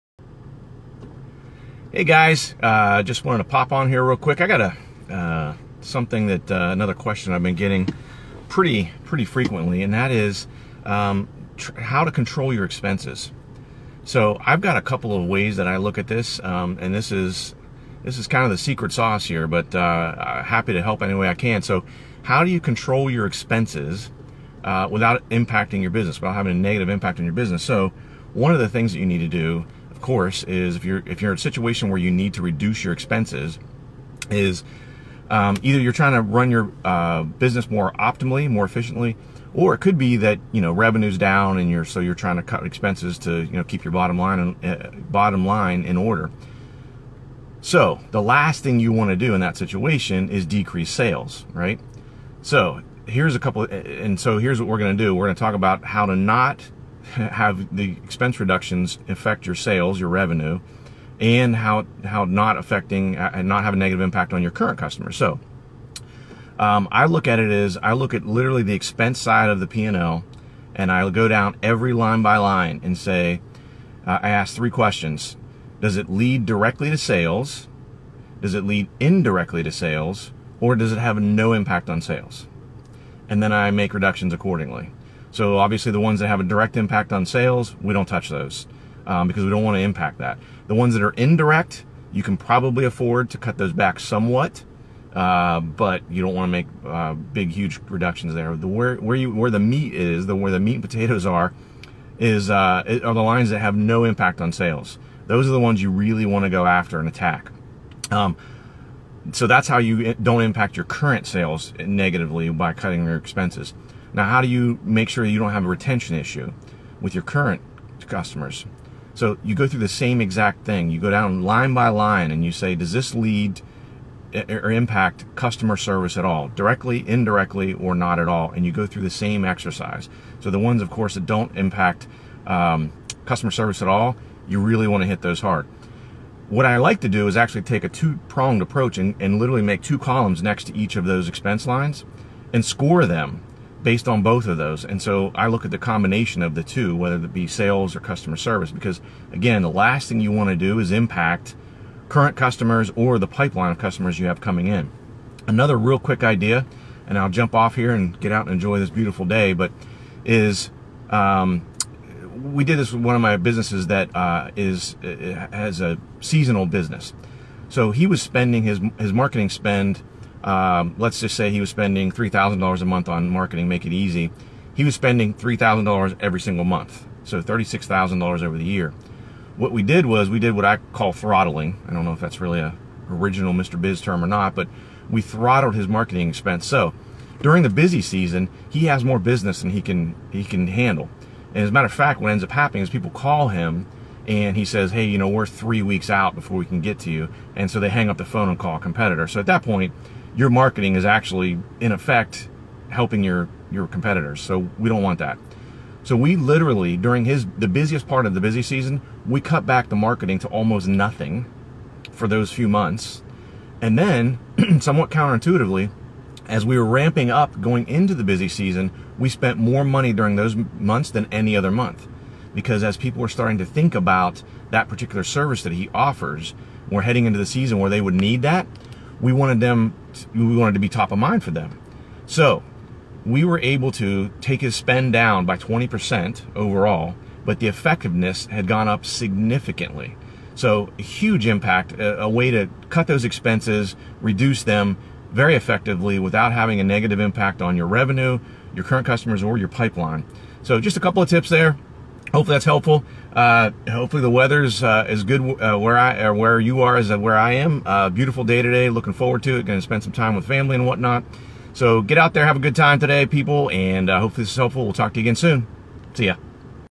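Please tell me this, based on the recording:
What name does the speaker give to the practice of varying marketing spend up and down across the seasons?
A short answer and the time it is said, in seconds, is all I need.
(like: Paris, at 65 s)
throttling, at 181 s.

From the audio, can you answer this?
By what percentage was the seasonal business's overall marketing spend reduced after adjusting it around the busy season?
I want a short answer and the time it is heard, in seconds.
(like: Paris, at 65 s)
20%, at 235 s.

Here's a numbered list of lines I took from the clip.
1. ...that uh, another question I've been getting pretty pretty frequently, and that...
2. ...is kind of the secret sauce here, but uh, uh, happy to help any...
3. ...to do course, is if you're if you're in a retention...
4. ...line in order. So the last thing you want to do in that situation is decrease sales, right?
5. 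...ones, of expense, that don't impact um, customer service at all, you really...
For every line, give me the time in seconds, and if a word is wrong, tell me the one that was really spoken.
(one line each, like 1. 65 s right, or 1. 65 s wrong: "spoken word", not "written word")
1. 6 s right
2. 18 s right
3. 29 s wrong: "situation", not "retention"
4. 45 s right
5. 130 s wrong: "course", not "expense".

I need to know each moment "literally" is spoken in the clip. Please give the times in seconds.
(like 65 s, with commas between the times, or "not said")
68 s, 139 s, 206 s.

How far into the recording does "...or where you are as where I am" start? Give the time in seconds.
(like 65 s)
256 s.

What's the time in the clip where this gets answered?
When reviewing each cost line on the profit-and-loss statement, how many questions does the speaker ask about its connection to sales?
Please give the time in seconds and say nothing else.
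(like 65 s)
74 s.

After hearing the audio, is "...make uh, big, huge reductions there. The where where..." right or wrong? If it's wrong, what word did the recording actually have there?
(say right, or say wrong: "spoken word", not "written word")
right.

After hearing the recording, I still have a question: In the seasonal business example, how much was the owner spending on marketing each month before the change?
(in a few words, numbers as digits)
$3,000.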